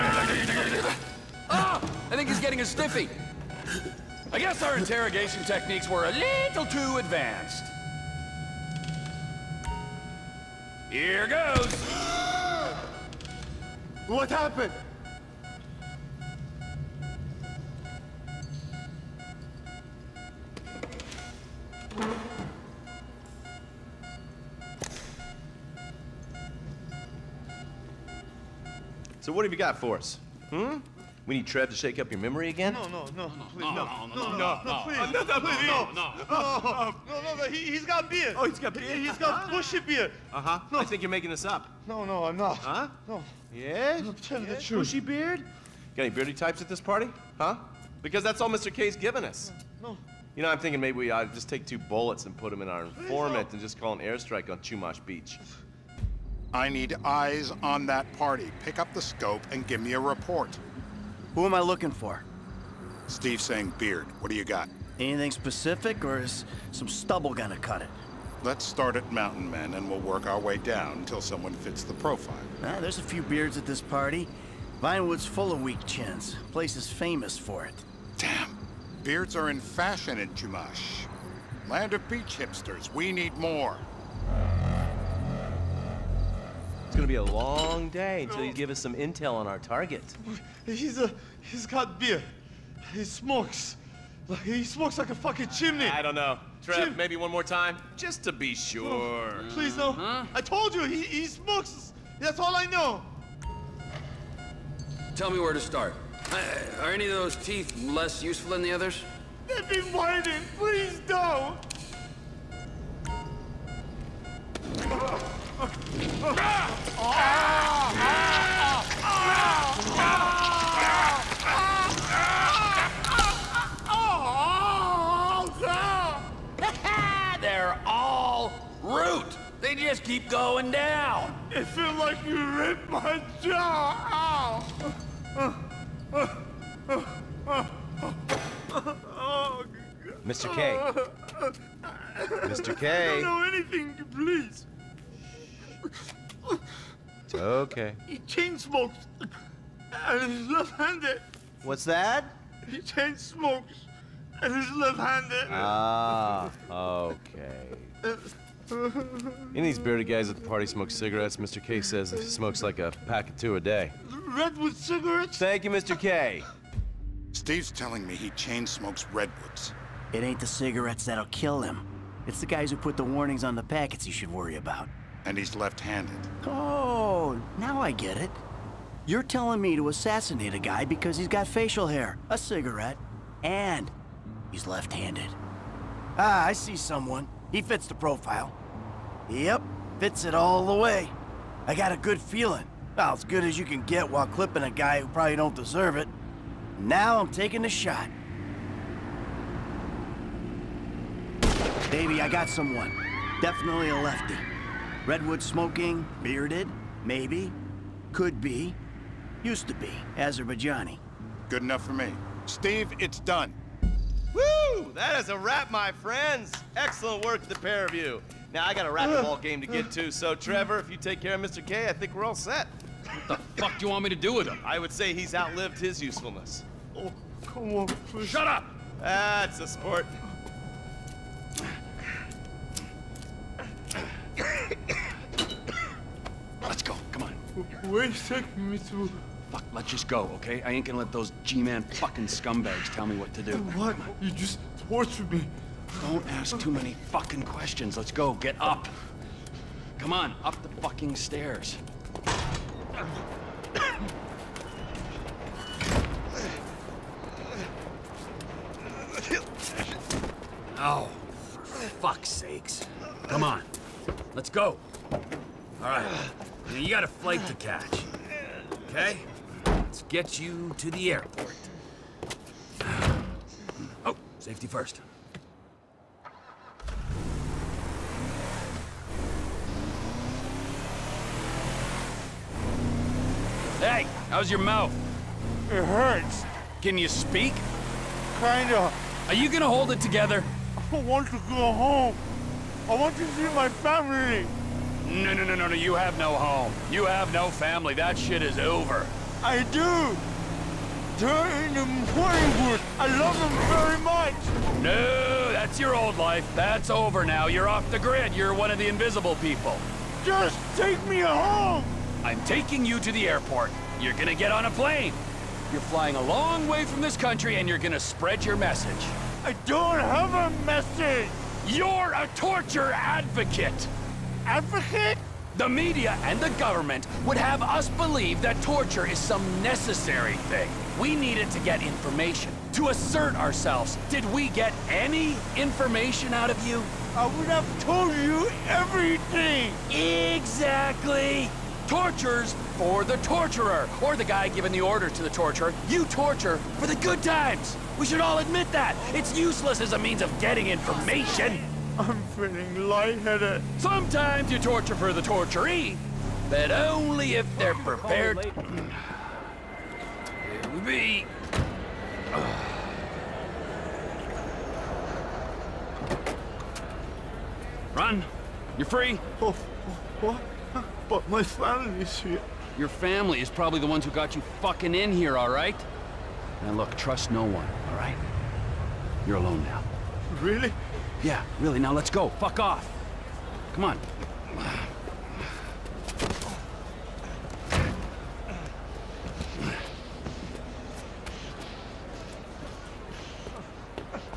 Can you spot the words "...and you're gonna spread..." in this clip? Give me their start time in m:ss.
5:17.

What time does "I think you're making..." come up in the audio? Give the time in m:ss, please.
0:40.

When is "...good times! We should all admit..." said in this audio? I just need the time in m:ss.
5:46.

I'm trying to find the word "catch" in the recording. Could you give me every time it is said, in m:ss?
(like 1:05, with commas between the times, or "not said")
4:27.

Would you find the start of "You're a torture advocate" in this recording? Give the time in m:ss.
5:21.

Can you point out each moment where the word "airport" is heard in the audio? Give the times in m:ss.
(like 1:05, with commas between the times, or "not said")
4:31, 5:13.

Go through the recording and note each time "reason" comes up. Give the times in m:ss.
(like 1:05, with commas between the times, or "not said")
not said.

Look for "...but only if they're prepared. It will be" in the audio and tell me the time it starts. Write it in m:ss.
5:56.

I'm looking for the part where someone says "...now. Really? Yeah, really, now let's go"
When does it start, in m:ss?
6:19.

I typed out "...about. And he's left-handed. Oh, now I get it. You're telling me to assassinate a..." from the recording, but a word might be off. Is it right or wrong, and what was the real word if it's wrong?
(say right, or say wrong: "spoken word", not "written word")
right.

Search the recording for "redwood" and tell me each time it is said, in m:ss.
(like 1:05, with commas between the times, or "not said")
2:44, 2:49, 3:25.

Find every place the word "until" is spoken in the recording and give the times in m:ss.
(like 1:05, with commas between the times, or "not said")
1:10, 1:28.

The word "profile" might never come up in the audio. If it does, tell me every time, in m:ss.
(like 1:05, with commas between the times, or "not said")
1:11, 3:07.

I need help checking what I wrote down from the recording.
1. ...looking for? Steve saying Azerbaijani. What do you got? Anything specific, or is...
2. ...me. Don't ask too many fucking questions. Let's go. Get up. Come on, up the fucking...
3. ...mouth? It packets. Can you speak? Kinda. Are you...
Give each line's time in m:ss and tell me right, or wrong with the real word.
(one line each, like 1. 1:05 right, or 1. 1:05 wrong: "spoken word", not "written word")
1. 1:01 wrong: "Beard", not "Azerbaijani"
2. 4:05 right
3. 4:44 wrong: "hurts", not "packets".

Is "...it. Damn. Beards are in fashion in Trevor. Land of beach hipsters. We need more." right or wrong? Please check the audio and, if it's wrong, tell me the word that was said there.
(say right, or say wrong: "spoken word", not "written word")
wrong: "Chumash", not "Trevor".